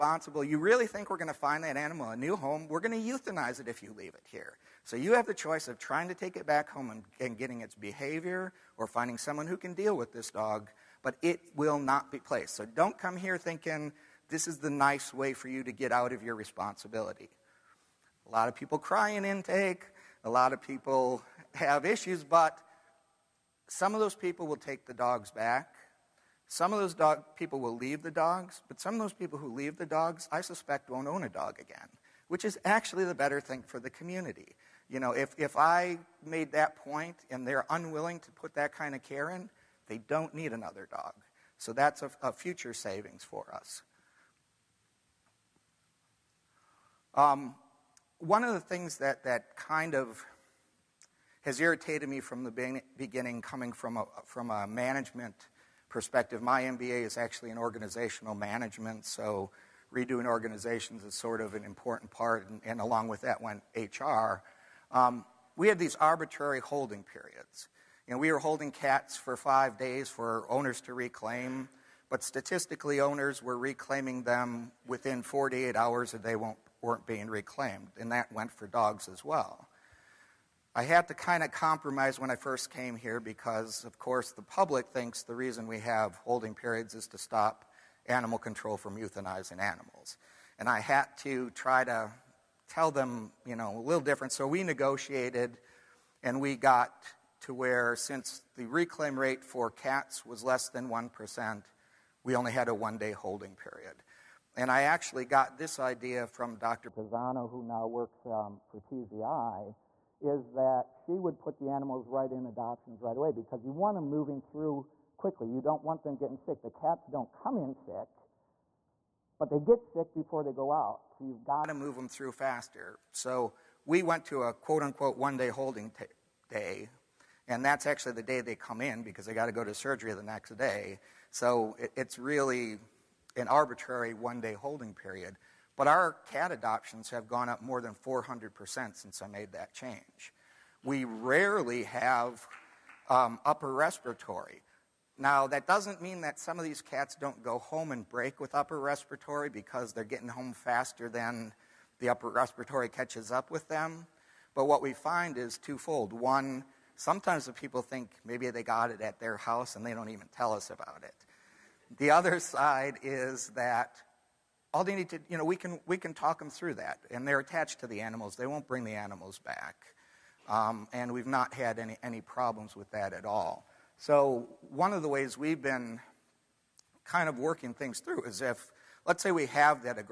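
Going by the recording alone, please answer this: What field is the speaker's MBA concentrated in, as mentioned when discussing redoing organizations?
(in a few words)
Organizational management.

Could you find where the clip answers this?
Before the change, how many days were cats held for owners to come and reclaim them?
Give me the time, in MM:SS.
01:09.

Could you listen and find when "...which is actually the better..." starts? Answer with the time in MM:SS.
00:32.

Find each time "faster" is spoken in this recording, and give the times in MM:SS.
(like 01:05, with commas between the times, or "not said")
02:02, 02:30.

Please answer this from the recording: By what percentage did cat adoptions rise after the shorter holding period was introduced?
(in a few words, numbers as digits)
More than 400%.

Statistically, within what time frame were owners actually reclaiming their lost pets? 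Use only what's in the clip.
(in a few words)
48 hours.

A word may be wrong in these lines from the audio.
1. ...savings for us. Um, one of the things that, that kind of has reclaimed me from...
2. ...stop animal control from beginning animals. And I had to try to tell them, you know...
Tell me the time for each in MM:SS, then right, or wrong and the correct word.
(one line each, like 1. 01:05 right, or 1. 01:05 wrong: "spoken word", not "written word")
1. 00:42 wrong: "irritated", not "reclaimed"
2. 01:27 wrong: "euthanizing", not "beginning".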